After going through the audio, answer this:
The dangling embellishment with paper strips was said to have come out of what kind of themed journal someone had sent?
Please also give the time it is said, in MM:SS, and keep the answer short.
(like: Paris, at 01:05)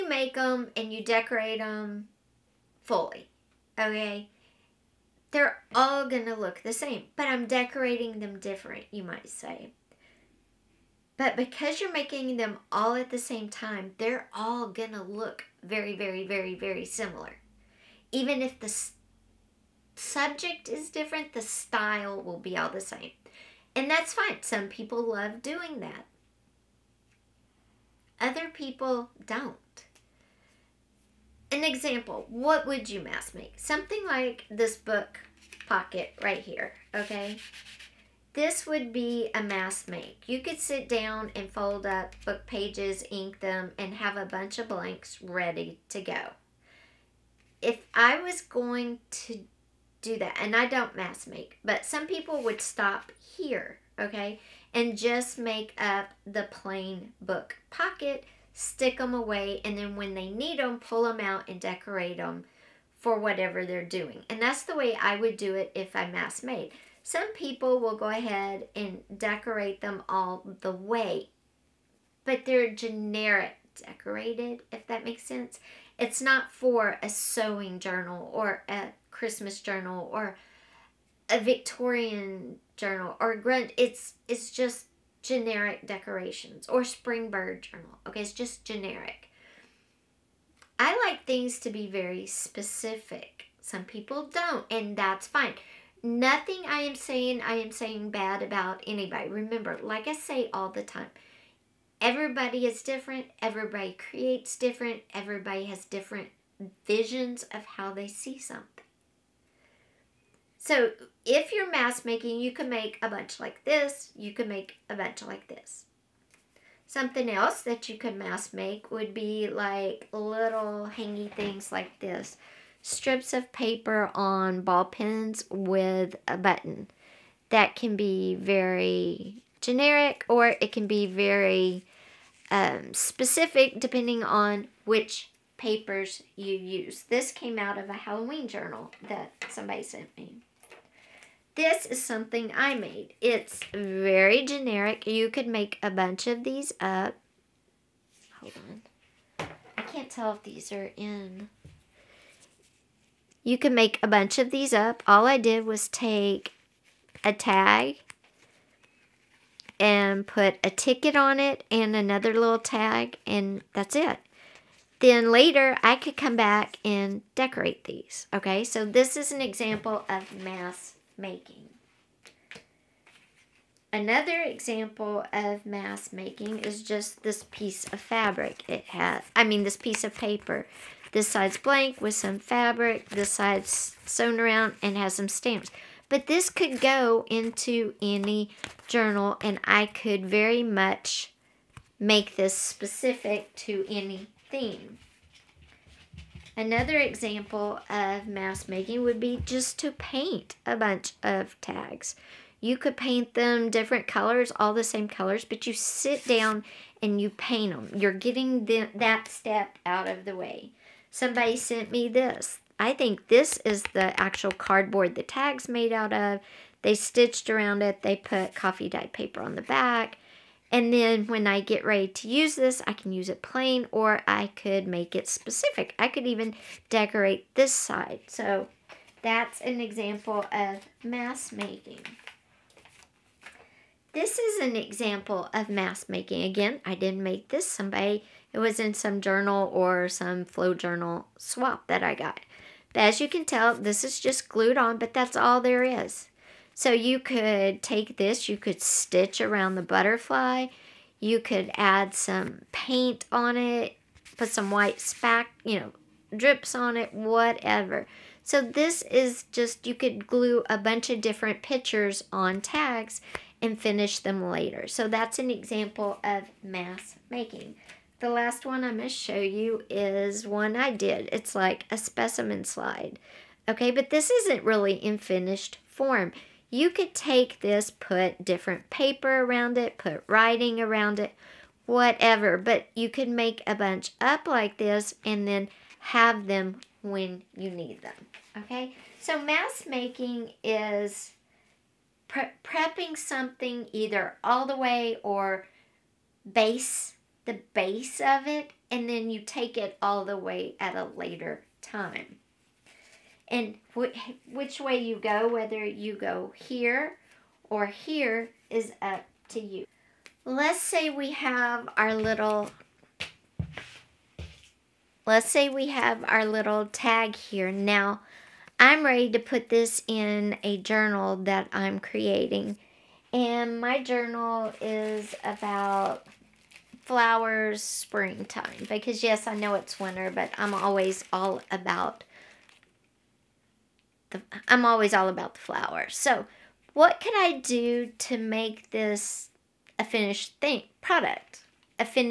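Halloween journal, at 02:17.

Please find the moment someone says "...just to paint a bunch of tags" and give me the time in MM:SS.
03:19.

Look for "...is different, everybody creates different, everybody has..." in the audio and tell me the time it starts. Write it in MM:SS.
01:42.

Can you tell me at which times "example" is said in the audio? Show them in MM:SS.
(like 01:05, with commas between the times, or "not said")
00:31, 02:49, 02:54, 03:16, 03:49, 03:54, 04:25.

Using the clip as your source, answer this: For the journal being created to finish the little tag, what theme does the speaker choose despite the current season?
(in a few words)
flowers springtime.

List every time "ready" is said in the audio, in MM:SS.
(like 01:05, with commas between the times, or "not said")
00:45, 03:41, 05:19.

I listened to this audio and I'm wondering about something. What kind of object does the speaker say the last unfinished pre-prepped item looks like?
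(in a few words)
specimen slide.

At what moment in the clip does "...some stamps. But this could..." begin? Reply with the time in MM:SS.
03:05.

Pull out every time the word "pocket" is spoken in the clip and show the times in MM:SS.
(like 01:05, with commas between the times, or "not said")
00:35, 00:57.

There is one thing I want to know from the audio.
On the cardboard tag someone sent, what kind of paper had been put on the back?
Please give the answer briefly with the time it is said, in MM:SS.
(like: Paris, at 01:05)
coffee dyed paper, at 03:38.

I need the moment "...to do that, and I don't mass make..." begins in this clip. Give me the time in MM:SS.
00:49.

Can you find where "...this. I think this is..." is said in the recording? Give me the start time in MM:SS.
03:32.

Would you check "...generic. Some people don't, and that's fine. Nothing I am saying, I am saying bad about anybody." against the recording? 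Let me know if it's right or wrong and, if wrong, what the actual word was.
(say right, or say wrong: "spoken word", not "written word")
wrong: "specific", not "generic".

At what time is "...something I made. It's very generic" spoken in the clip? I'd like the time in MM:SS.
02:22.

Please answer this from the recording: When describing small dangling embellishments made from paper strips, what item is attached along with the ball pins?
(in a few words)
a button.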